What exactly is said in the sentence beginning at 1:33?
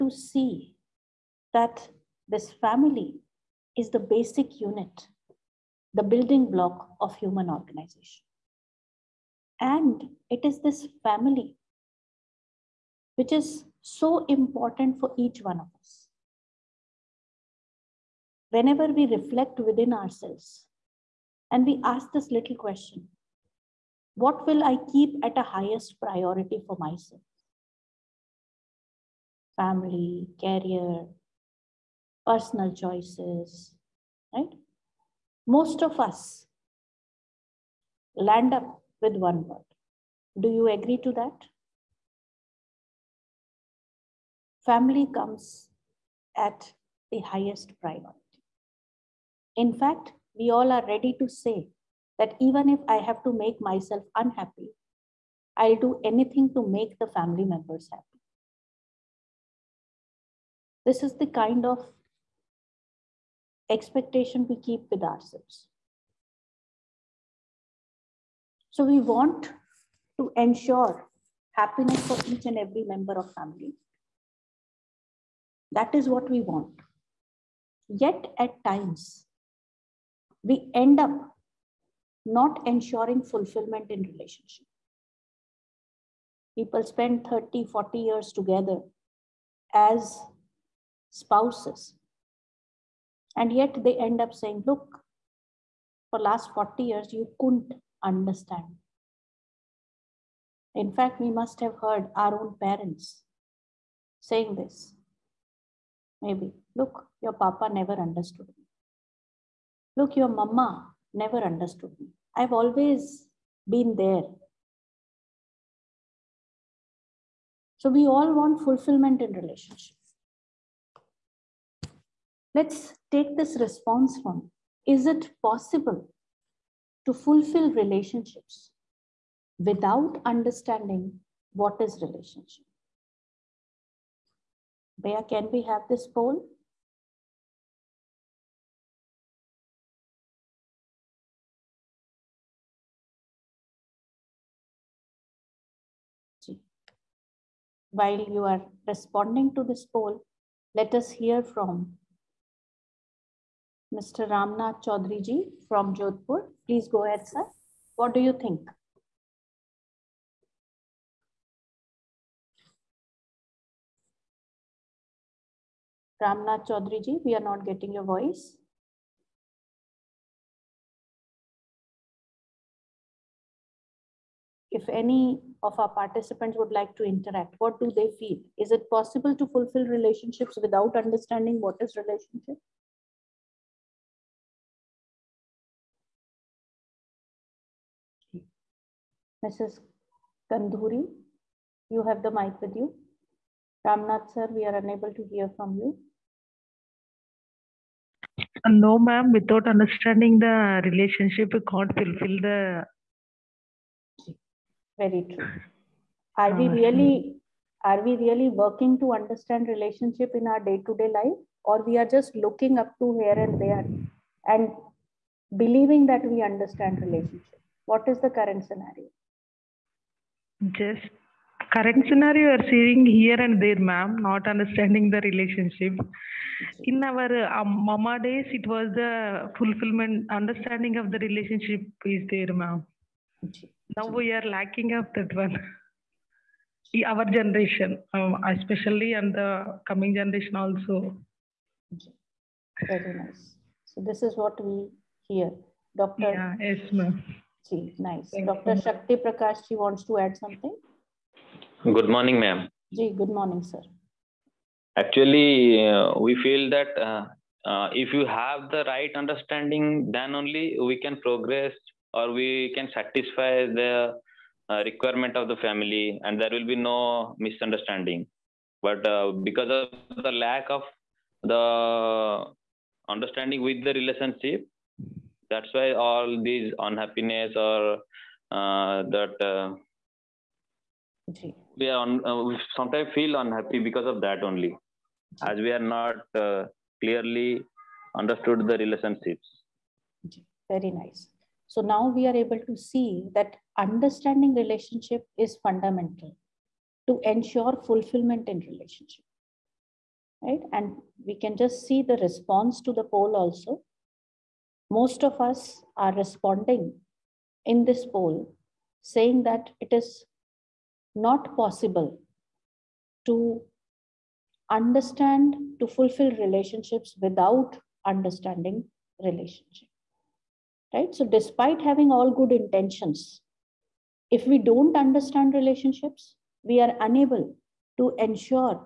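And yet they end up saying, look, for last 40 years, you couldn't understand.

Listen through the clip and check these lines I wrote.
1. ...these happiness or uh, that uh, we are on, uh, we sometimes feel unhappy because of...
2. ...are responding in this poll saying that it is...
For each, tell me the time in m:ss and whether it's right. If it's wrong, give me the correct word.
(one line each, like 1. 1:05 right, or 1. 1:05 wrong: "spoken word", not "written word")
1. 4:36 wrong: "unhappiness", not "happiness"
2. 5:05 right.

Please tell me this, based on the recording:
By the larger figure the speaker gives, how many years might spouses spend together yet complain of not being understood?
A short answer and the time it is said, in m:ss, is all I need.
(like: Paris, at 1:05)
40, at 1:27.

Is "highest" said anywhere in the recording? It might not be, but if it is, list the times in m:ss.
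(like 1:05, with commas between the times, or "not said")
0:25, 0:47.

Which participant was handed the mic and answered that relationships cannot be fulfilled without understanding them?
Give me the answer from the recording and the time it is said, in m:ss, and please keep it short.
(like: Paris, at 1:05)
Mrs. Kandhuri, at 3:09.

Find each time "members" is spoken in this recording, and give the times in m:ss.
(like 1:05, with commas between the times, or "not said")
0:57, 1:12.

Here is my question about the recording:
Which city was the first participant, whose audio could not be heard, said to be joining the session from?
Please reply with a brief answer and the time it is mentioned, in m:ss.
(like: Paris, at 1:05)
Jodhpur, at 2:35.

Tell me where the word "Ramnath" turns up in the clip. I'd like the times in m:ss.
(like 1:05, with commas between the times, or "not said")
2:34, 2:46, 3:13.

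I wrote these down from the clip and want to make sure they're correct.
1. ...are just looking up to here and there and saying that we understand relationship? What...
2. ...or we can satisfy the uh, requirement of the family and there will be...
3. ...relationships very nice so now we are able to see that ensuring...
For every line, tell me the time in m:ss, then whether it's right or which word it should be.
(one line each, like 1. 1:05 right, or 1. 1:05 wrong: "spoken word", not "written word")
1. 3:32 wrong: "believing", not "saying"
2. 4:22 right
3. 4:48 wrong: "understanding", not "ensuring".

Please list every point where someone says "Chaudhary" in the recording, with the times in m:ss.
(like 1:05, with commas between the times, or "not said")
2:34, 2:46.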